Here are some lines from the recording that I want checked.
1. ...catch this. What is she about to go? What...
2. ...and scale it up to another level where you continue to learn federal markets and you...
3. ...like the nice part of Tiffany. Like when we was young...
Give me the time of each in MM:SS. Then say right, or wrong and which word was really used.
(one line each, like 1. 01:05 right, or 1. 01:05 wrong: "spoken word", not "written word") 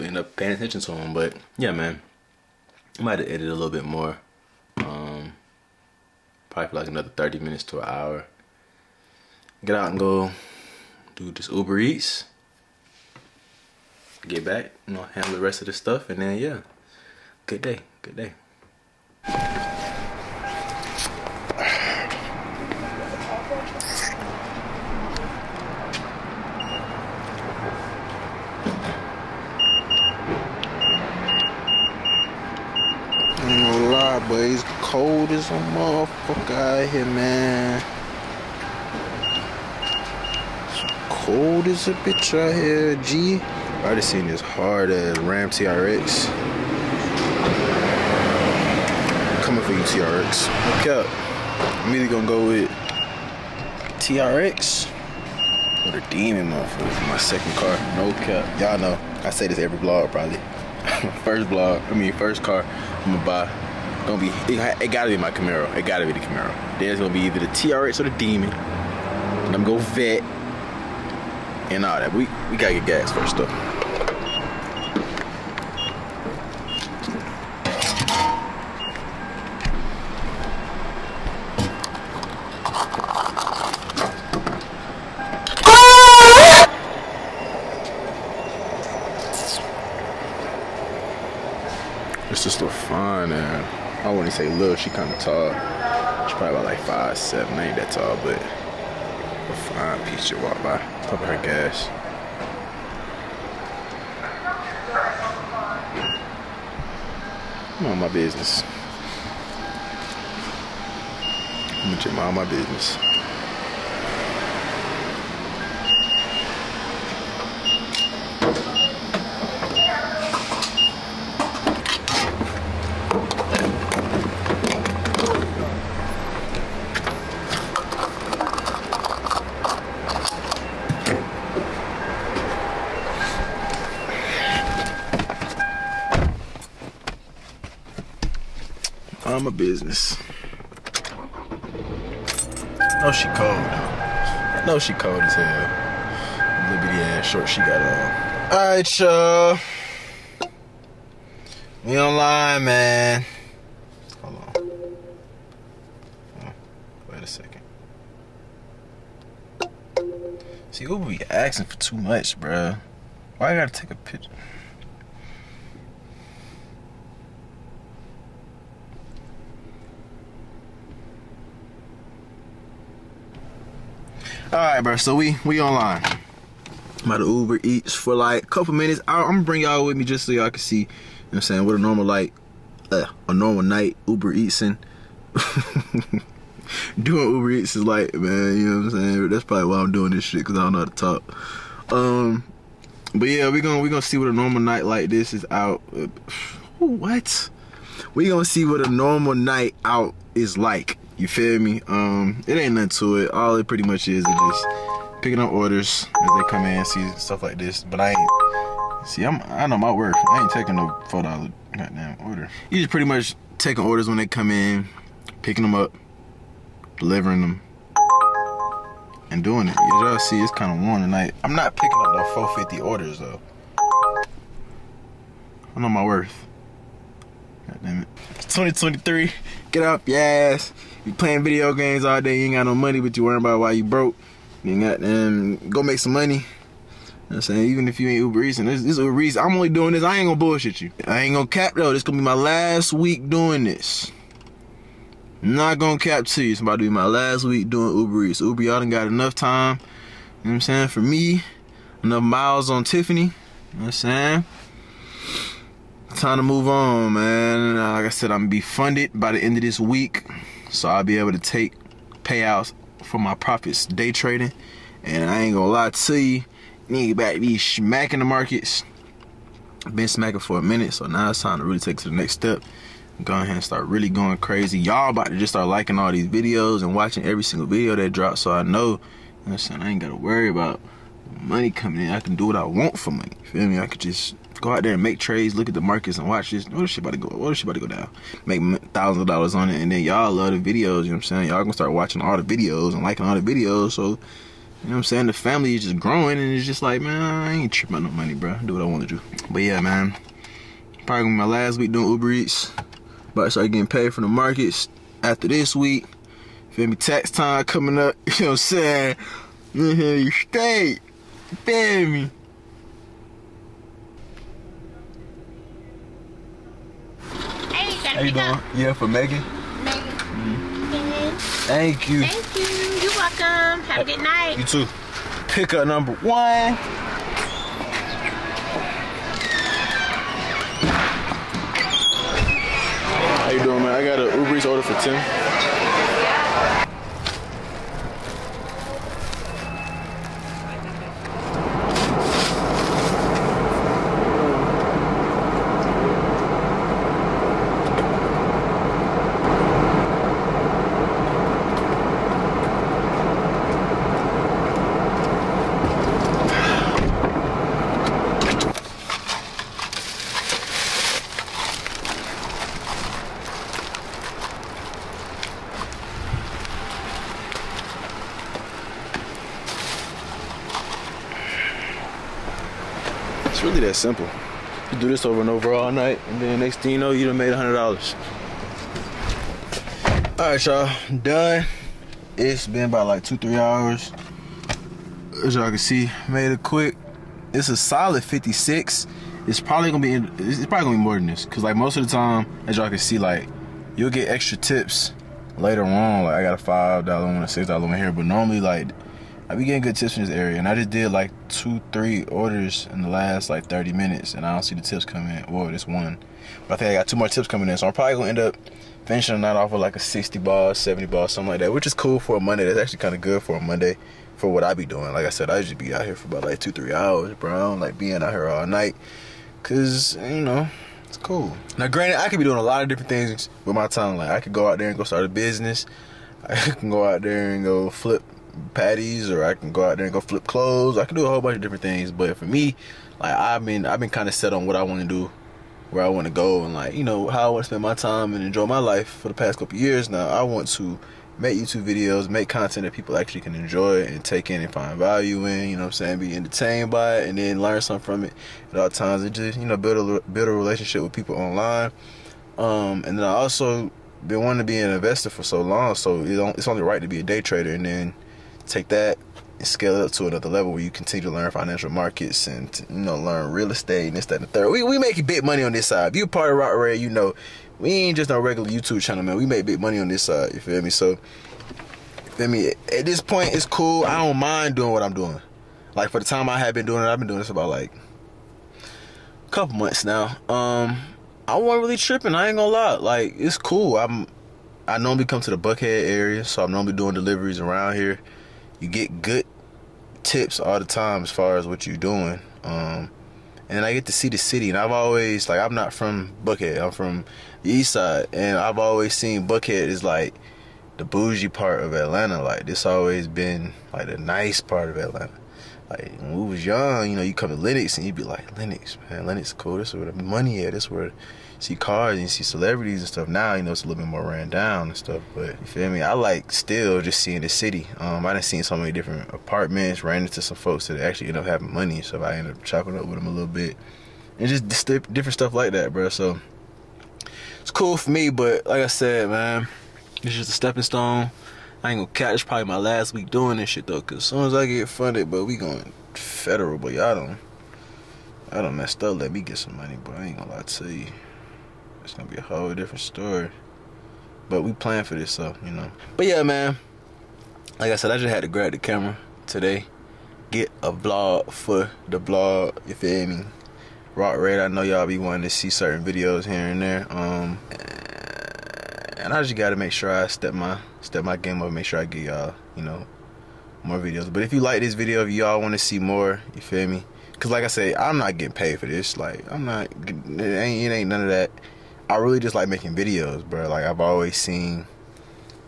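1. 04:46 wrong: "watch", not "catch"
2. 07:39 wrong: "financial", not "federal"
3. 08:23 wrong: "Atlanta", not "Tiffany".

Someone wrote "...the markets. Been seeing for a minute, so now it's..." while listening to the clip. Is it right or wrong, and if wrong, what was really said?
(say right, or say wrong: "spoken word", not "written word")
wrong: "smacking", not "seeing".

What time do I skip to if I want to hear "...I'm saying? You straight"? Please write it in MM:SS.
05:08.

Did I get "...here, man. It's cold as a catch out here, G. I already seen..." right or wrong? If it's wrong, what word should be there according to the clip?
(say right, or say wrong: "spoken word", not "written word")
wrong: "bitch", not "catch".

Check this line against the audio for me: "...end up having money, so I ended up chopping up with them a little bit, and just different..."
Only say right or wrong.
right.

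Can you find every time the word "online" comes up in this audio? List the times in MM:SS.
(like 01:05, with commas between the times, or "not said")
02:31, 02:55, 07:31.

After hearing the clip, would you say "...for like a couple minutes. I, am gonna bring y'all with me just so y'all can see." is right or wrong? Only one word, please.
right.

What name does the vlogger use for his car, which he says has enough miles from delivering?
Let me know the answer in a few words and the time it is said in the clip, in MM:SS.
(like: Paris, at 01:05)
Tiffany, at 04:12.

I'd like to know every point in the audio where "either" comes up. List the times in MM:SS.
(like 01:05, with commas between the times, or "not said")
00:51, 01:07.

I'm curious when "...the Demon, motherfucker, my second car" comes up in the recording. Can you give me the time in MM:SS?
00:55.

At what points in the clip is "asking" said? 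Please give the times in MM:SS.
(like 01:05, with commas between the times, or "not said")
02:41.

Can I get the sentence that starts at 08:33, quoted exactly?
Now you know it's a little bit more ran down and stuff.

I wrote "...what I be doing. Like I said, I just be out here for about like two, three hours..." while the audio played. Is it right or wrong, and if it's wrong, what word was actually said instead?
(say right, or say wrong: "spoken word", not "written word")
right.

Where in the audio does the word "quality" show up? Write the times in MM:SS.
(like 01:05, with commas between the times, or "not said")
not said.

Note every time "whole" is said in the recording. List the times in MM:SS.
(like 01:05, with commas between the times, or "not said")
07:11, 09:02.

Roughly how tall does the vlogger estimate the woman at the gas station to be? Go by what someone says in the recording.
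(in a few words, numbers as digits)
5'7".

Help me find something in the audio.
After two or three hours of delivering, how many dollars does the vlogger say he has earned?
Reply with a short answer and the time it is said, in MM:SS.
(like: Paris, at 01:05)
56, at 06:28.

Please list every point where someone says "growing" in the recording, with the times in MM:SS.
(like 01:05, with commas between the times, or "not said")
04:55.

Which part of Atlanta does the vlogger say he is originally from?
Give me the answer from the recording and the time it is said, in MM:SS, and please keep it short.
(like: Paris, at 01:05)
East Side, at 08:17.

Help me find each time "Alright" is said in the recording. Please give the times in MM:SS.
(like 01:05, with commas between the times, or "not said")
02:28.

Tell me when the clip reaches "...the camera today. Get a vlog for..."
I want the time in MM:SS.
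09:08.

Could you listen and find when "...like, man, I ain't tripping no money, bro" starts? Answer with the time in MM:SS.
04:56.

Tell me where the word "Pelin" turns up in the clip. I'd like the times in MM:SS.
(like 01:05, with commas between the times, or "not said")
not said.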